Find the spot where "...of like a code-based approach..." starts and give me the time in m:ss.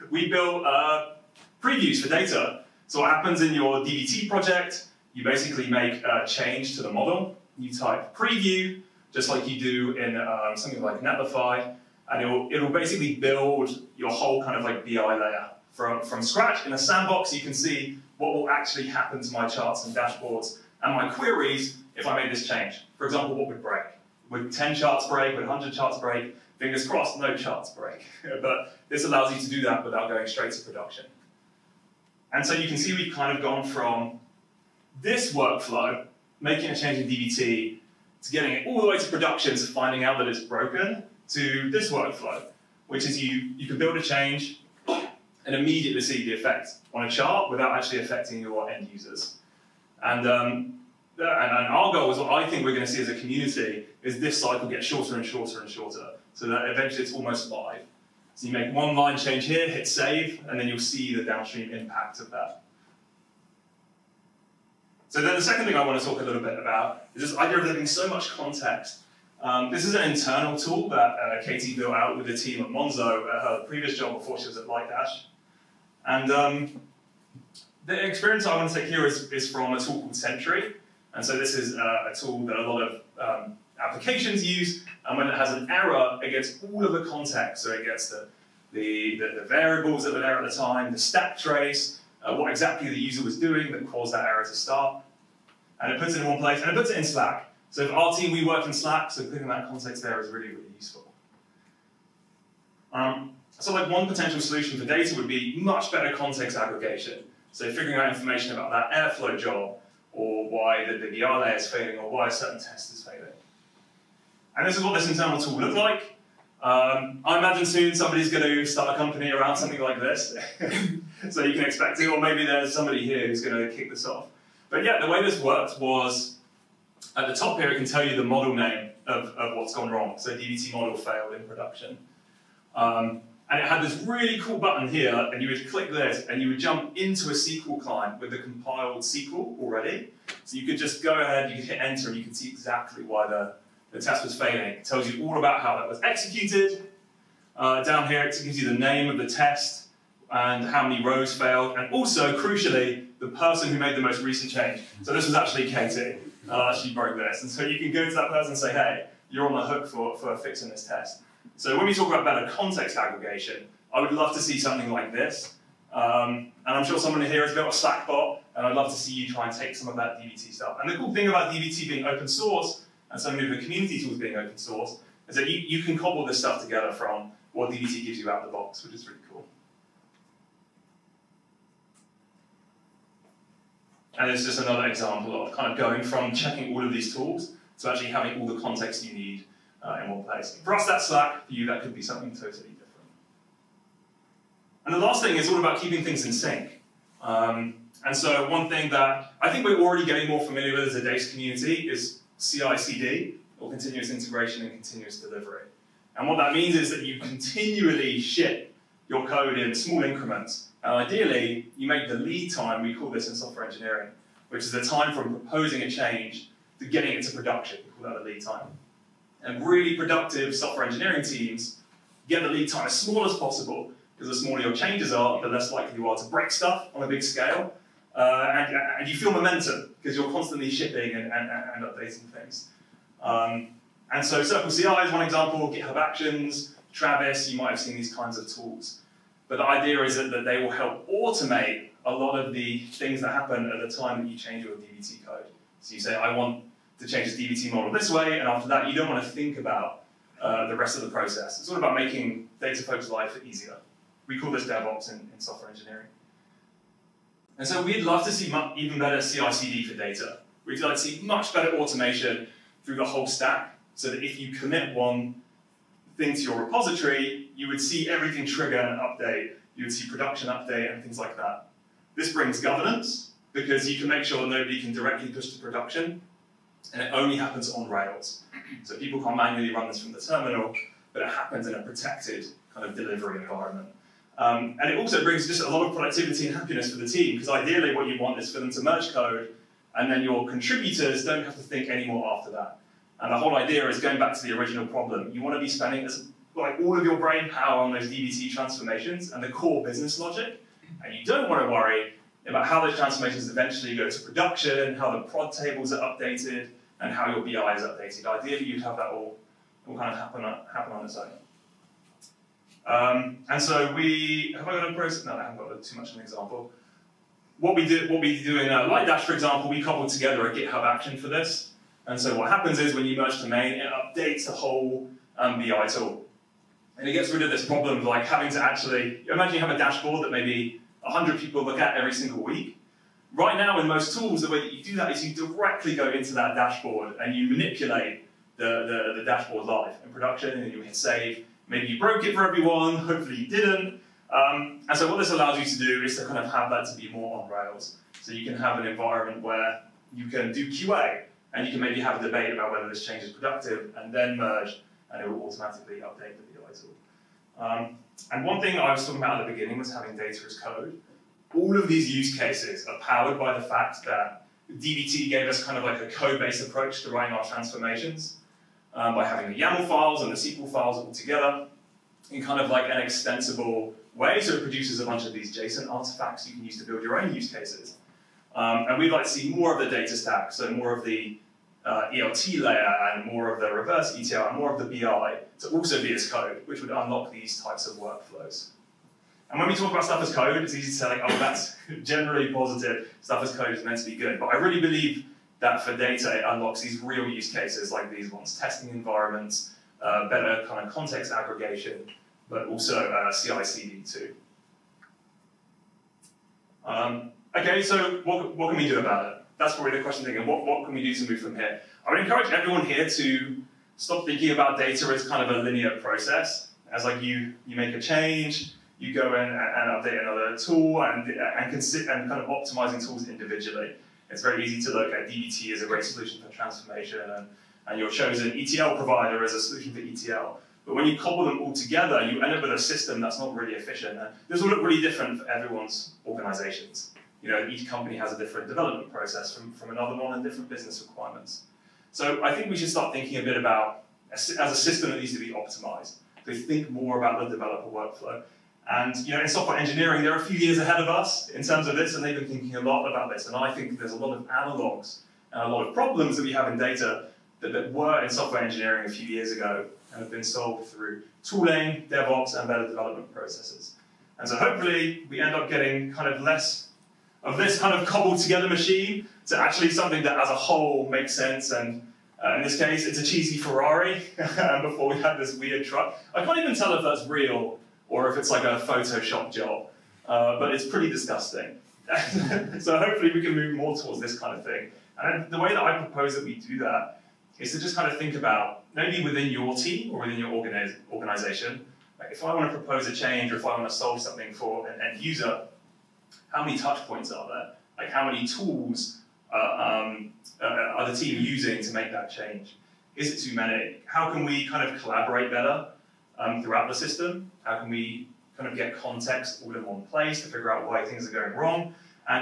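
6:05.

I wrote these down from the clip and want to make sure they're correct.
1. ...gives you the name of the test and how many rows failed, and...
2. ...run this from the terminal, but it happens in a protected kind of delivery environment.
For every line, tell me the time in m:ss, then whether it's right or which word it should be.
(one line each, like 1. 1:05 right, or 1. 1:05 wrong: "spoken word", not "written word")
1. 2:28 right
2. 4:39 right.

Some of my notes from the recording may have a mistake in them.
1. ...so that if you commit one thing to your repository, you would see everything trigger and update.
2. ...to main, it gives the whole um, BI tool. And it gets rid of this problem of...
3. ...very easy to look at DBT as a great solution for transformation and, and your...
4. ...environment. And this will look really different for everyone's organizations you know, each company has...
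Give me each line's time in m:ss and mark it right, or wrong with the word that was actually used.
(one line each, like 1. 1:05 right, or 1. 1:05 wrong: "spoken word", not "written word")
1. 4:23 right
2. 5:23 wrong: "updates", not "gives"
3. 7:04 right
4. 7:13 wrong: "efficient", not "environment".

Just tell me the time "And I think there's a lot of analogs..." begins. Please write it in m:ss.
7:33.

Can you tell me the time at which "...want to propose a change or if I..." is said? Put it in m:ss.
8:12.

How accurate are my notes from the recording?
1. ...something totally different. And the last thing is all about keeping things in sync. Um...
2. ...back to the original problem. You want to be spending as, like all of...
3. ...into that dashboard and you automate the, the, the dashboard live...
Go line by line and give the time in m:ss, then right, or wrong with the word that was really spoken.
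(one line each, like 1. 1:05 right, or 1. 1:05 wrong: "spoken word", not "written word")
1. 3:12 right
2. 4:54 right
3. 5:36 wrong: "manipulate", not "automate".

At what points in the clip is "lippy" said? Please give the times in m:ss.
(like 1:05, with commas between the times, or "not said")
not said.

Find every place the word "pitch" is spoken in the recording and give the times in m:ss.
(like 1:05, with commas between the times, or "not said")
not said.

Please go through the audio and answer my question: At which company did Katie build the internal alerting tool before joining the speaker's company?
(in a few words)
Monzo.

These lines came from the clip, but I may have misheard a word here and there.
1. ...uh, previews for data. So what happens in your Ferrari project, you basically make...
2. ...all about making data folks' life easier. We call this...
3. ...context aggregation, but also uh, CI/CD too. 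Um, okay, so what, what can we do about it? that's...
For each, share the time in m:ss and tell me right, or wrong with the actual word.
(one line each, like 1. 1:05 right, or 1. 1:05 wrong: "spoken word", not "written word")
1. 0:00 wrong: "DBT", not "Ferrari"
2. 4:11 right
3. 6:40 right.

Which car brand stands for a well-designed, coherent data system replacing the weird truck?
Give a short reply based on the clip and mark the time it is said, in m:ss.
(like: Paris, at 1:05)
Ferrari, at 7:53.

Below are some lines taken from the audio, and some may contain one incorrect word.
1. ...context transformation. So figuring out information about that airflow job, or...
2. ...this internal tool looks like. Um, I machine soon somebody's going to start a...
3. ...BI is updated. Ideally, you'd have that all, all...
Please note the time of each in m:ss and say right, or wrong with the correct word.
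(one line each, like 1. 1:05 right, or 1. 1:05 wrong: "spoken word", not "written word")
1. 1:46 wrong: "aggregation", not "transformation"
2. 1:54 wrong: "imagine", not "machine"
3. 5:07 right.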